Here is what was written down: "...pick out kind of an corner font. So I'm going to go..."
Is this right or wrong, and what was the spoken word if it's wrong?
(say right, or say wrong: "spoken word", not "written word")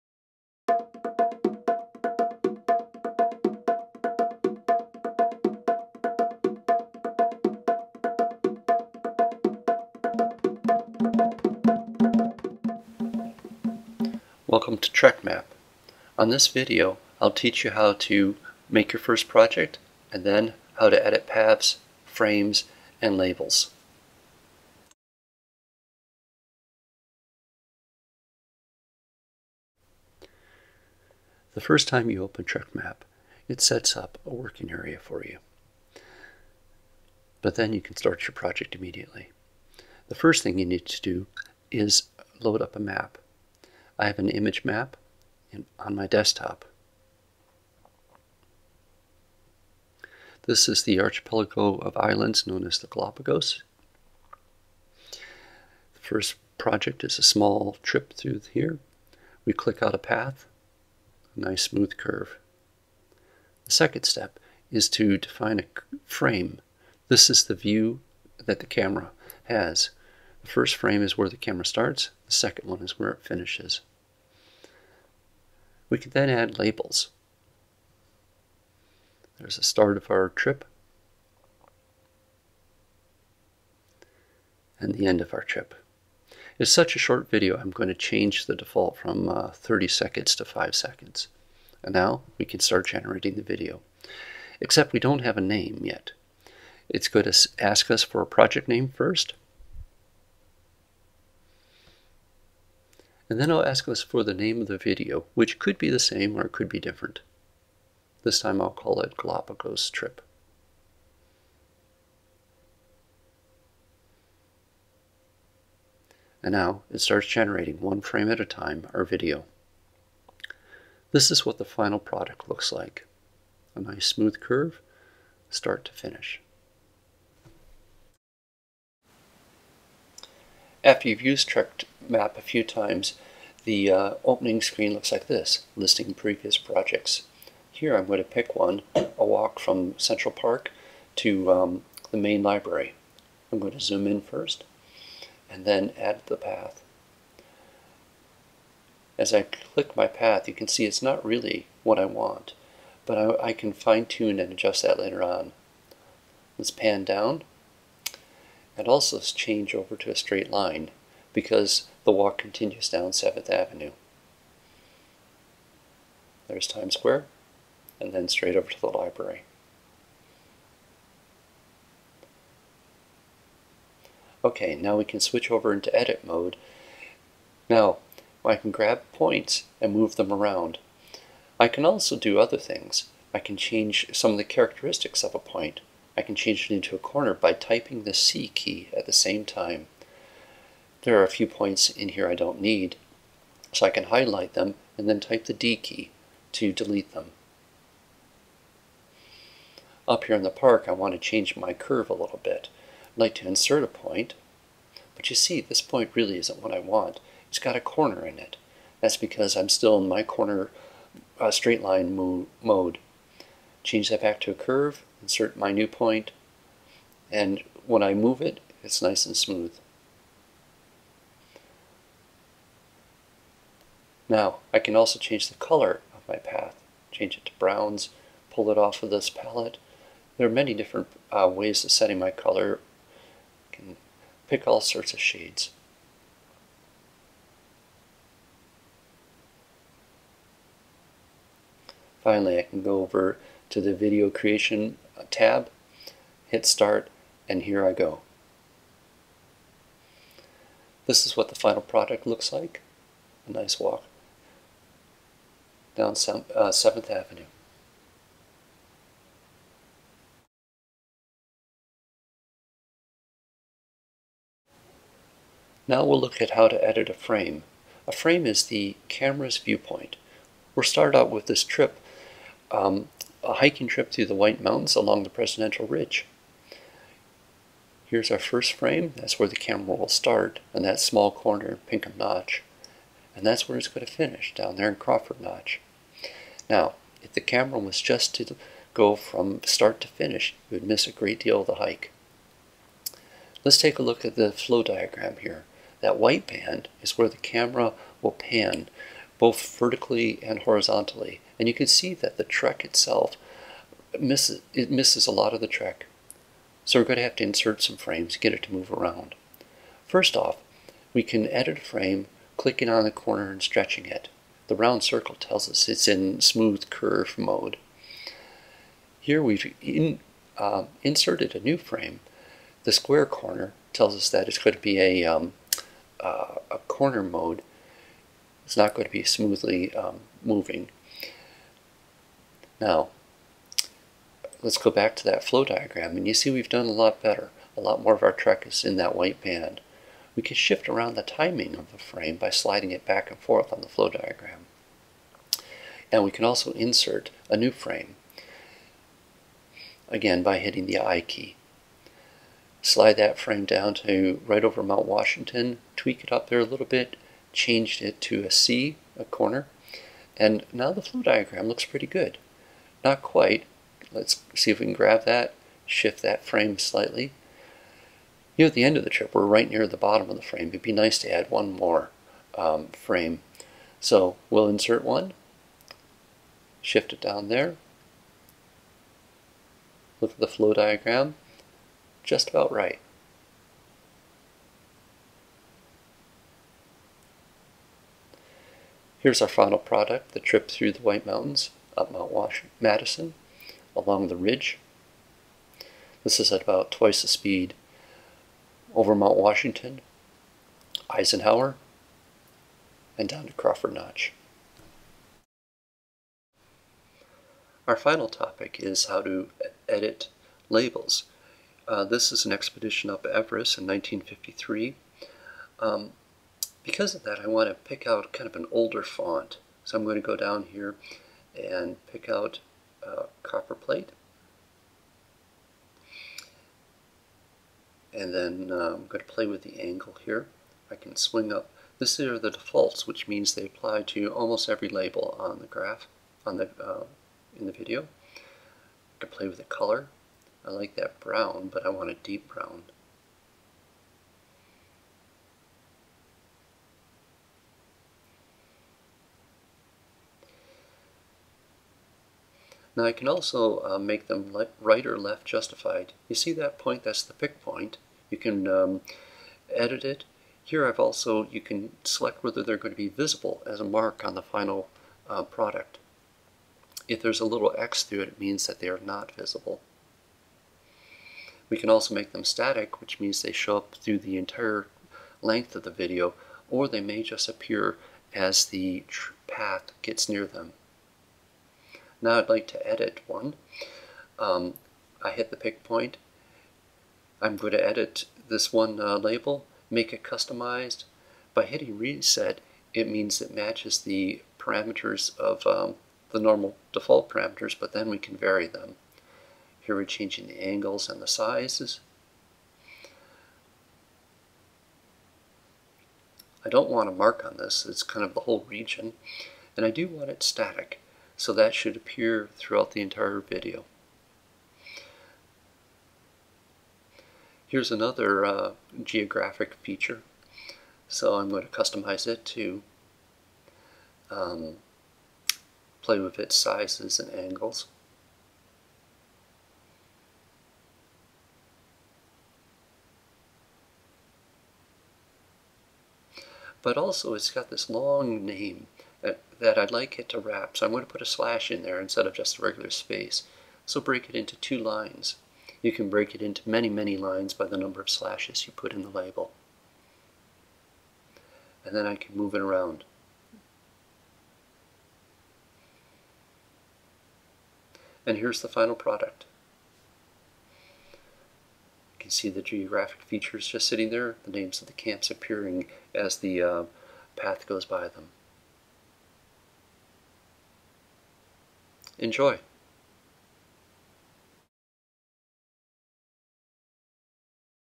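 wrong: "older", not "corner".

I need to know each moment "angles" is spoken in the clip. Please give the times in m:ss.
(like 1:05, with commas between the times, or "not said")
7:09, 8:20, 8:47.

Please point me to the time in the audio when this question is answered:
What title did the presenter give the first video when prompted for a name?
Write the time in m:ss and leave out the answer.
1:49.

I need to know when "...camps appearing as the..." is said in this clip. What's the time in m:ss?
9:24.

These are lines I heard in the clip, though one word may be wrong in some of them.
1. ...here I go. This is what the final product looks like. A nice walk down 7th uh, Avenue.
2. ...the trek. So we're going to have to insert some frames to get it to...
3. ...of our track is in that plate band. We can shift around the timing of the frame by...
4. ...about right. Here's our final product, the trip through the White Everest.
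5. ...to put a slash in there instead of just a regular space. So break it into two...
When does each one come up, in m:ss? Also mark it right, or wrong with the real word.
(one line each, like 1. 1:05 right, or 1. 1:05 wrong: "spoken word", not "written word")
1. 4:07 right
2. 5:05 right
3. 5:38 wrong: "white", not "plate"
4. 6:22 wrong: "Mountains", not "Everest"
5. 9:01 right.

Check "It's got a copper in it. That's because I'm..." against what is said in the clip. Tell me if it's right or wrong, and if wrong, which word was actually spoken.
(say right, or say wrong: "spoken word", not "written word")
wrong: "corner", not "copper".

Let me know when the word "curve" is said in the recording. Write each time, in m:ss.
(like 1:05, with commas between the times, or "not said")
1:01, 2:04, 3:21, 3:34, 5:16.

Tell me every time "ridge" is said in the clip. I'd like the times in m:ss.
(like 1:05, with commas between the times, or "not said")
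4:35, 6:34.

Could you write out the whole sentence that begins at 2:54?
Okay, now we can switch over into edit mode.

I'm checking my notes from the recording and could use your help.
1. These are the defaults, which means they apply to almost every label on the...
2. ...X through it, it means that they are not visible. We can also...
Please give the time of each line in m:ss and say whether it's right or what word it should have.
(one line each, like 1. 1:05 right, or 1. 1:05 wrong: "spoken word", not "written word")
1. 7:11 right
2. 7:47 right.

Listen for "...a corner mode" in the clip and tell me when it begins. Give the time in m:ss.
5:26.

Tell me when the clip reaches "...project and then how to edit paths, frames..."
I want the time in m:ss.
0:19.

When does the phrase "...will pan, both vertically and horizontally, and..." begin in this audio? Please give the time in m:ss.
4:58.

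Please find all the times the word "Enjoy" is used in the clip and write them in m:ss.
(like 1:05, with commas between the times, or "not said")
9:32.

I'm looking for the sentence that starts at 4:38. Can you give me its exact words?
Here's our first frame, that's where the camera will start, and that small corner, Pinkham Notch.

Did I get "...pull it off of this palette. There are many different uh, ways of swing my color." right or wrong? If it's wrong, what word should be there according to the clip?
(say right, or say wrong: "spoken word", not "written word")
wrong: "setting", not "swing".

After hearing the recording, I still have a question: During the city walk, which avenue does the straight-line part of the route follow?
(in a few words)
7th Avenue.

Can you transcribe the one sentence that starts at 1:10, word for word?
The first frame is where the camera starts, the second one is where it finishes.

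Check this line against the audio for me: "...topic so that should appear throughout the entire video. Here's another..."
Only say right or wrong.
wrong.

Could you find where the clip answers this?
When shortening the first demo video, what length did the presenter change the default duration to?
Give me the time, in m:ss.
1:30.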